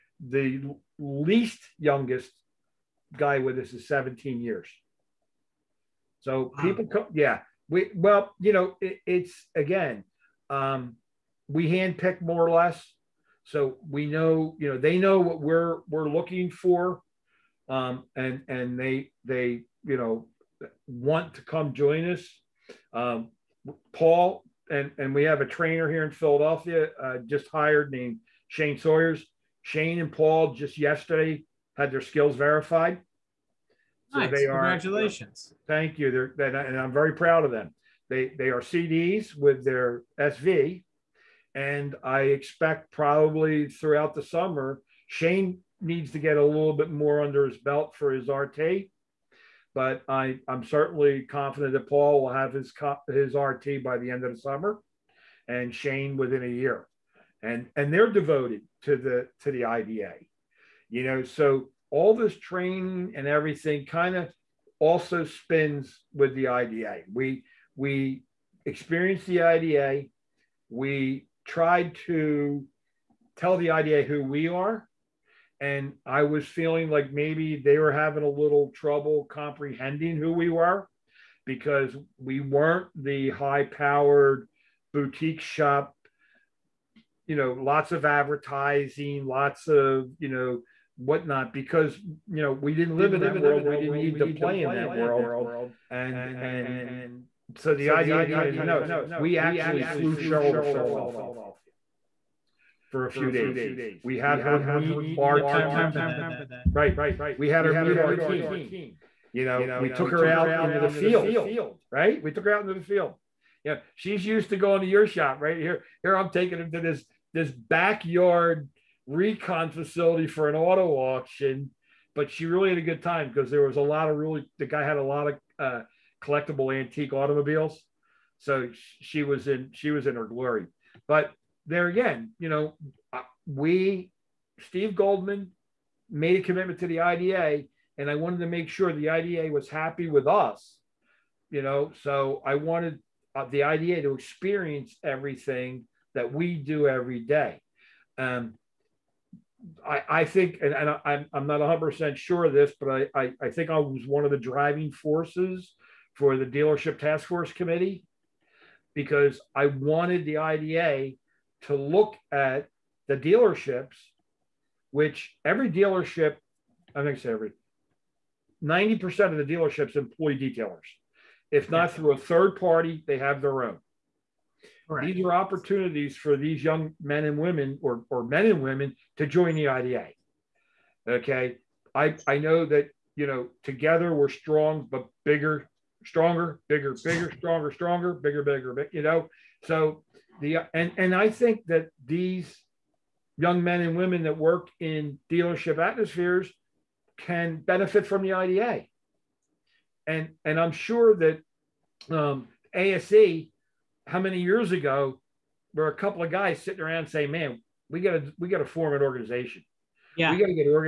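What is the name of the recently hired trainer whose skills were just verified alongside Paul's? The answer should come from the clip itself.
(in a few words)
Shane Sawyer's.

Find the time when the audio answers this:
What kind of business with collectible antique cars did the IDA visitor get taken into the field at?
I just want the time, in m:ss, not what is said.
2:00.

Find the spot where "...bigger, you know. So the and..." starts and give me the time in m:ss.
3:08.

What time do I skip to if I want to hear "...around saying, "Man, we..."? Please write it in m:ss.
3:26.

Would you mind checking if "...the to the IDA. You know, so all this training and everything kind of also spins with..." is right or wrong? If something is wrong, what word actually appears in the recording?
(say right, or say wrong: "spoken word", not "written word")
right.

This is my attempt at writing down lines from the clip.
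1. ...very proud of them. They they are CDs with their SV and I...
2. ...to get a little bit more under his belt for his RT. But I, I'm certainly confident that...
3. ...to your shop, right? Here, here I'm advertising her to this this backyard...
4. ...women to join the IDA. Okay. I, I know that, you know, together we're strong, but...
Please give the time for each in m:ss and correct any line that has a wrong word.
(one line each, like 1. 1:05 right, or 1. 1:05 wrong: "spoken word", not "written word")
1. 0:36 right
2. 0:46 right
3. 1:54 wrong: "taking", not "advertising"
4. 2:58 right.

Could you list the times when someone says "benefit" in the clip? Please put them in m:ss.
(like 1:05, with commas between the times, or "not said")
3:17.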